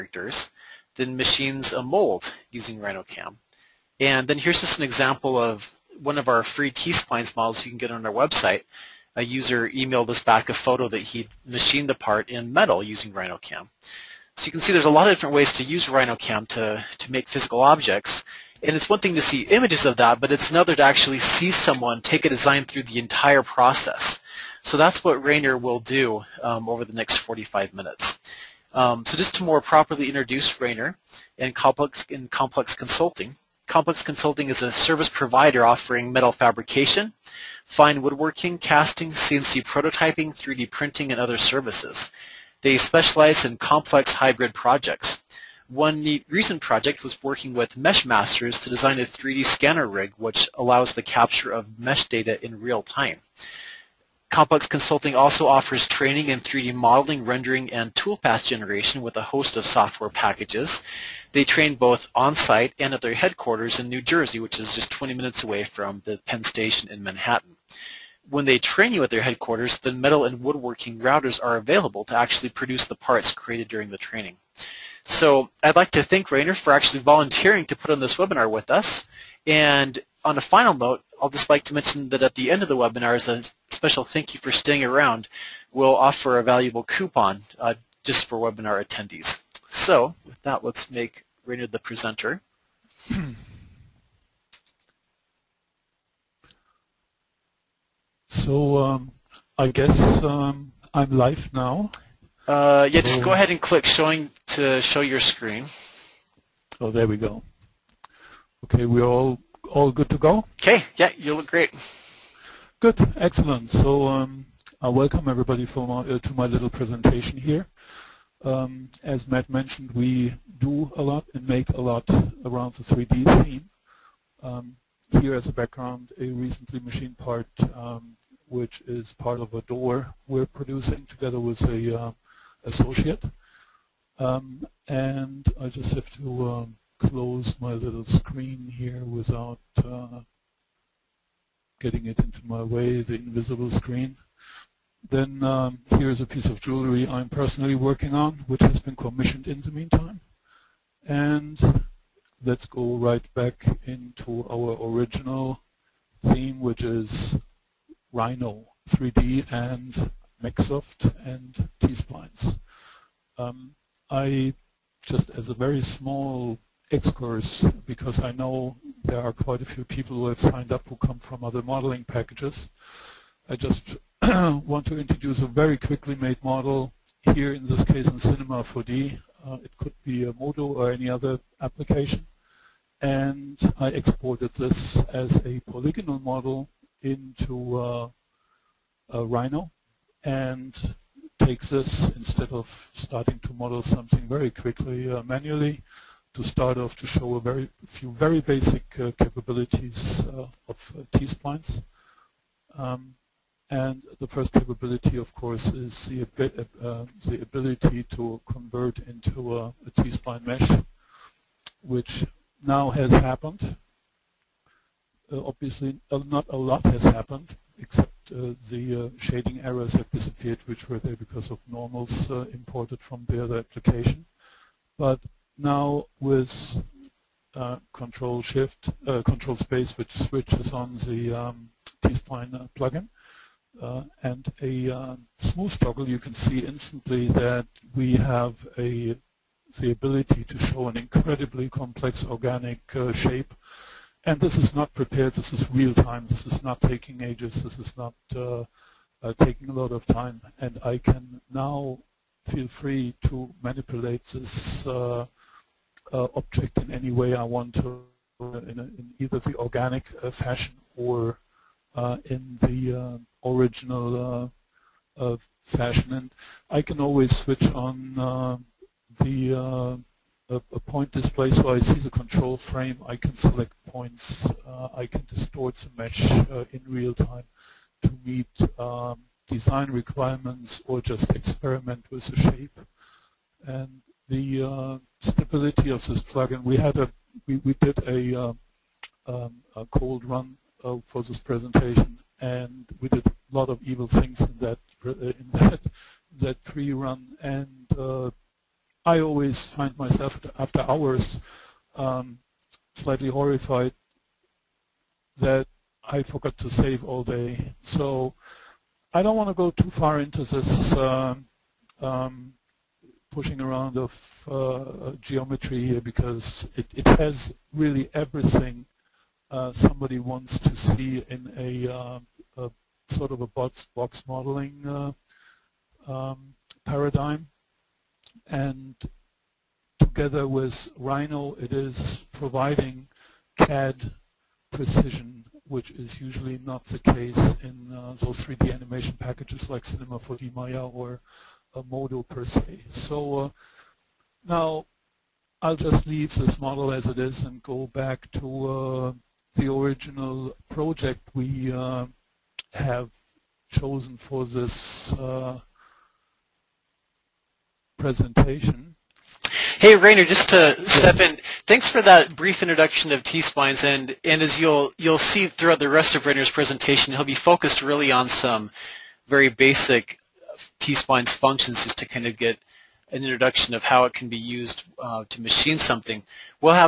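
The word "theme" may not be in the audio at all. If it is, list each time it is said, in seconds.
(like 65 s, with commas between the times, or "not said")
123 s, 156 s.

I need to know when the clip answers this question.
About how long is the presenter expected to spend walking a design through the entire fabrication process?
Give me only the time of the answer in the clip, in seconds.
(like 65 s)
27 s.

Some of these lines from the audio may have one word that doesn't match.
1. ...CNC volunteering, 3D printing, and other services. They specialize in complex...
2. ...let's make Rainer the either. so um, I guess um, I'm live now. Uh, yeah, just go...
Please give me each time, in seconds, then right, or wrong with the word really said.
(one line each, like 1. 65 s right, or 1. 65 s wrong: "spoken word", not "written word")
1. 39 s wrong: "prototyping", not "volunteering"
2. 90 s wrong: "presenter", not "either".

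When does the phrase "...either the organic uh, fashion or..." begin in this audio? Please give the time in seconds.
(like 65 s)
259 s.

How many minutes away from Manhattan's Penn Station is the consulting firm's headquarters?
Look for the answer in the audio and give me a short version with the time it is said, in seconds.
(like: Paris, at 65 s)
20, at 64 s.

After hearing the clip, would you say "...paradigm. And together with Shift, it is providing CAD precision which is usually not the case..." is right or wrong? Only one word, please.
wrong.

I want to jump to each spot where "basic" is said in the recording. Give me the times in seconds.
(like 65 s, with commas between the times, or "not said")
198 s, 369 s.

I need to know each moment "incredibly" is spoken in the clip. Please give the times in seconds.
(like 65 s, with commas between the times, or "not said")
240 s.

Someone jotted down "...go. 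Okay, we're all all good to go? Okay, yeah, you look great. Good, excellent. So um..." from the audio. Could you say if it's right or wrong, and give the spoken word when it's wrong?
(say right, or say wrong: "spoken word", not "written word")
right.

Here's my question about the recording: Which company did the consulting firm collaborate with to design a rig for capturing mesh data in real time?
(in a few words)
Mesh Masters.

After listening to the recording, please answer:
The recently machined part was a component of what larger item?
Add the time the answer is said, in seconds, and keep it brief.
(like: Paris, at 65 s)
A door, at 129 s.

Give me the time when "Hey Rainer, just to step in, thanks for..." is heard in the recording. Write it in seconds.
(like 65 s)
359 s.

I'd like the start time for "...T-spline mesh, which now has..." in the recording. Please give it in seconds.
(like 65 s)
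209 s.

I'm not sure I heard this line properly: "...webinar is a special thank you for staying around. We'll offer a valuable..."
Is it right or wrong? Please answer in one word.
right.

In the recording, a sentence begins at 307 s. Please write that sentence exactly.
So I don't want to go too far into this.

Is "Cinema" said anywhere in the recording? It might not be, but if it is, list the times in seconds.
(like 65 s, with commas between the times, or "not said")
178 s, 339 s.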